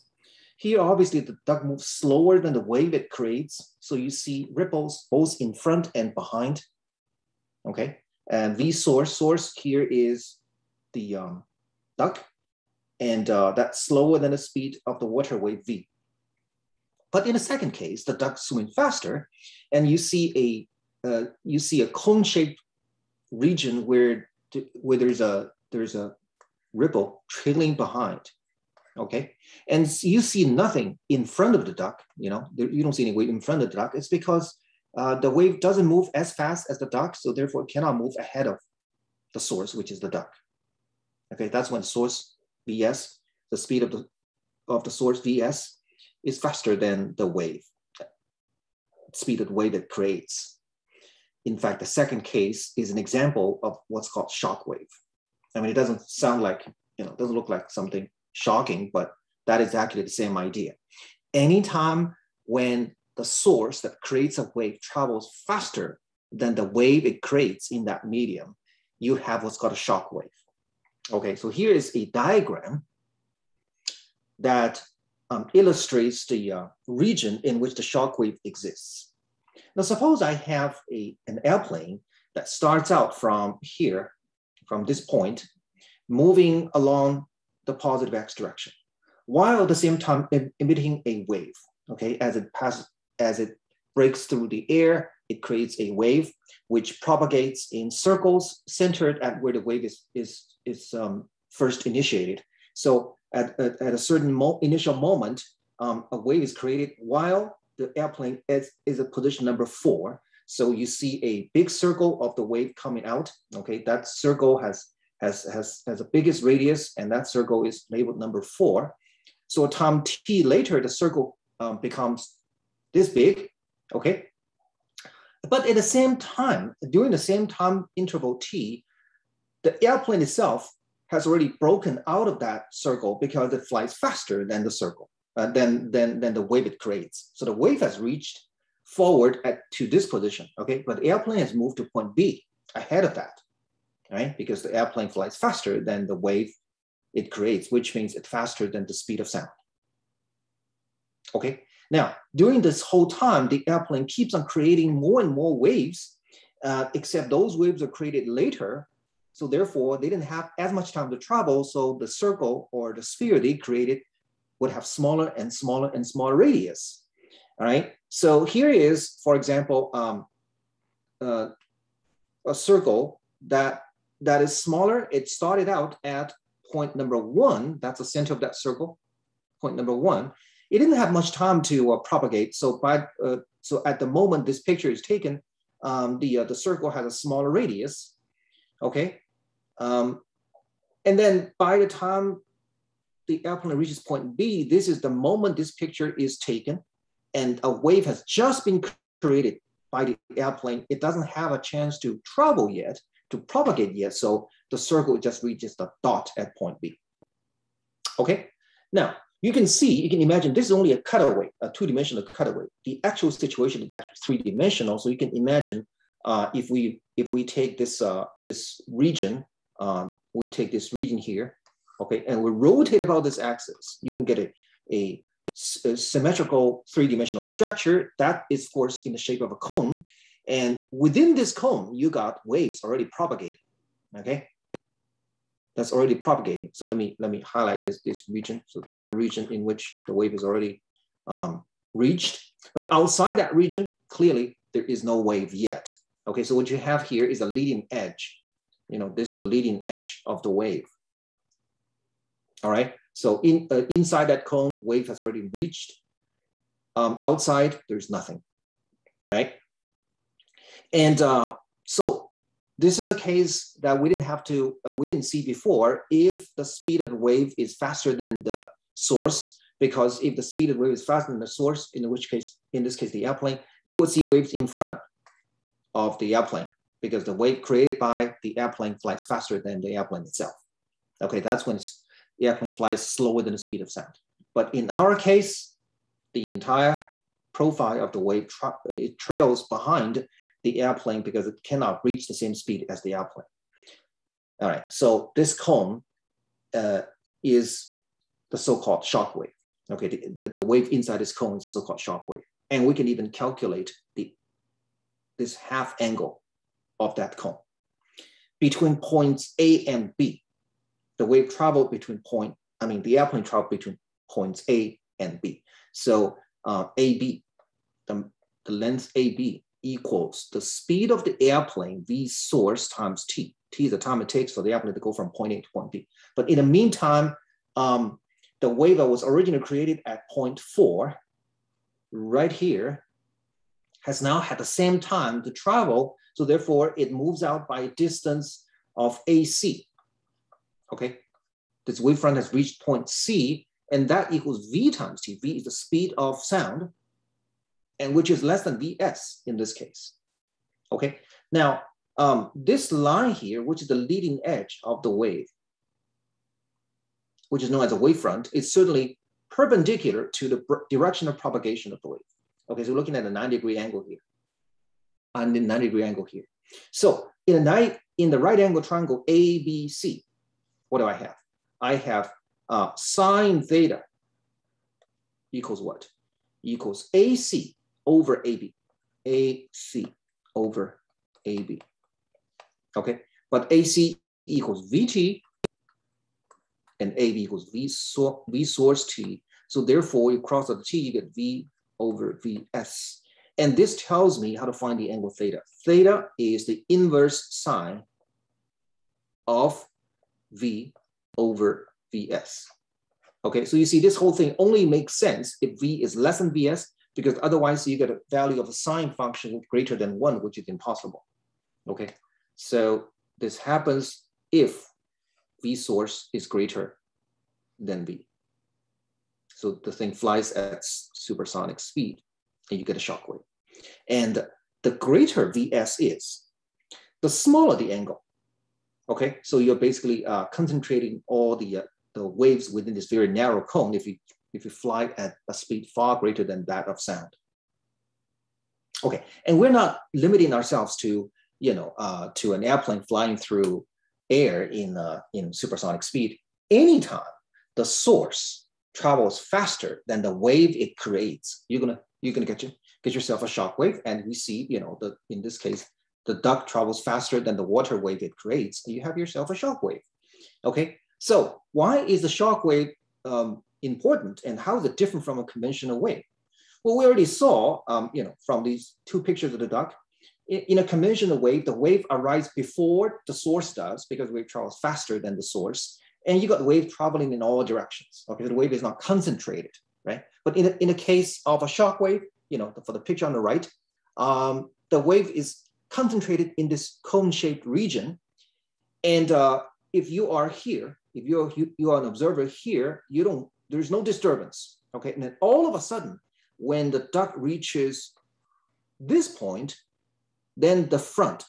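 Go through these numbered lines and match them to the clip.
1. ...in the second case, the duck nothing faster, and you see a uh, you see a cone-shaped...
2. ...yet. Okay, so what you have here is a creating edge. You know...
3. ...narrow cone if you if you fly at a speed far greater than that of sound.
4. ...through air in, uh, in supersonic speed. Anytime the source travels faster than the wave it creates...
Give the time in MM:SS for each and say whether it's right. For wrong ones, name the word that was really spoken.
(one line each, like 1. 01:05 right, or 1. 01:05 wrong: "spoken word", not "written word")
1. 00:17 wrong: "swimming", not "nothing"
2. 04:05 wrong: "leading", not "creating"
3. 07:13 right
4. 07:23 right.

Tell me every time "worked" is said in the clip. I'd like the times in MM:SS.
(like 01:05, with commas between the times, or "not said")
not said.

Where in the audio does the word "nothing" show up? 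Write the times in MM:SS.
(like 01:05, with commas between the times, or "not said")
00:30, 04:18.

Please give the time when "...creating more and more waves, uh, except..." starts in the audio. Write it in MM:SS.
02:34.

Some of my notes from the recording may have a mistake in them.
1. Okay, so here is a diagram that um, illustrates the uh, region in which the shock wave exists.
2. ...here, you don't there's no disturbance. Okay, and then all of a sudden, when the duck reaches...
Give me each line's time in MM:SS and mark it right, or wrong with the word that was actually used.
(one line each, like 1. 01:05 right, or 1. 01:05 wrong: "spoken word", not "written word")
1. 01:11 right
2. 08:12 right.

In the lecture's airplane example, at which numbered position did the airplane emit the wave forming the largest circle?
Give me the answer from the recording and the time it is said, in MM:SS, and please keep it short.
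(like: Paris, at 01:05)
4, at 01:49.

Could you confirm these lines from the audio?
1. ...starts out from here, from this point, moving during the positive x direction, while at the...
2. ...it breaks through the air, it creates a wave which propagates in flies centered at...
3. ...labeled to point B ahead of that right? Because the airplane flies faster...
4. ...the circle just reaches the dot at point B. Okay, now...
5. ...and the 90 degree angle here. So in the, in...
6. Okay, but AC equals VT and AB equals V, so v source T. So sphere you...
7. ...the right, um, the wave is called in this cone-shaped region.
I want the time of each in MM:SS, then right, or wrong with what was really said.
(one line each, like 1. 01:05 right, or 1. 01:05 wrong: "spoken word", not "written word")
1. 01:22 wrong: "along", not "during"
2. 01:33 wrong: "circles", not "flies"
3. 02:21 wrong: "moved", not "labeled"
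4. 03:24 right
5. 06:05 right
6. 06:22 wrong: "therefore", not "sphere"
7. 08:03 wrong: "concentrated", not "called".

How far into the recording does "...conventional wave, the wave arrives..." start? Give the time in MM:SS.
07:50.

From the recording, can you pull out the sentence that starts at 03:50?
And within this cone, you got waves already propagating, okay?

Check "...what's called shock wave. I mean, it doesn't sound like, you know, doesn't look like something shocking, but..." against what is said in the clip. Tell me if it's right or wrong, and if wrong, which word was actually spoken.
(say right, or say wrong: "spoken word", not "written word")
right.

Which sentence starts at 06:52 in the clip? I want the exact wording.
So this happens if V source is greater than V.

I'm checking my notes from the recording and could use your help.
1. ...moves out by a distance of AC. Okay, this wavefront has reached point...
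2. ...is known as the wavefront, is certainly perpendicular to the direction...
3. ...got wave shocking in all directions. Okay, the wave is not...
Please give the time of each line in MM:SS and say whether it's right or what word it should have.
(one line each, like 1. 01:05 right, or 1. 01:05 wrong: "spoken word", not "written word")
1. 05:37 right
2. 05:57 right
3. 07:56 wrong: "traveling", not "shocking".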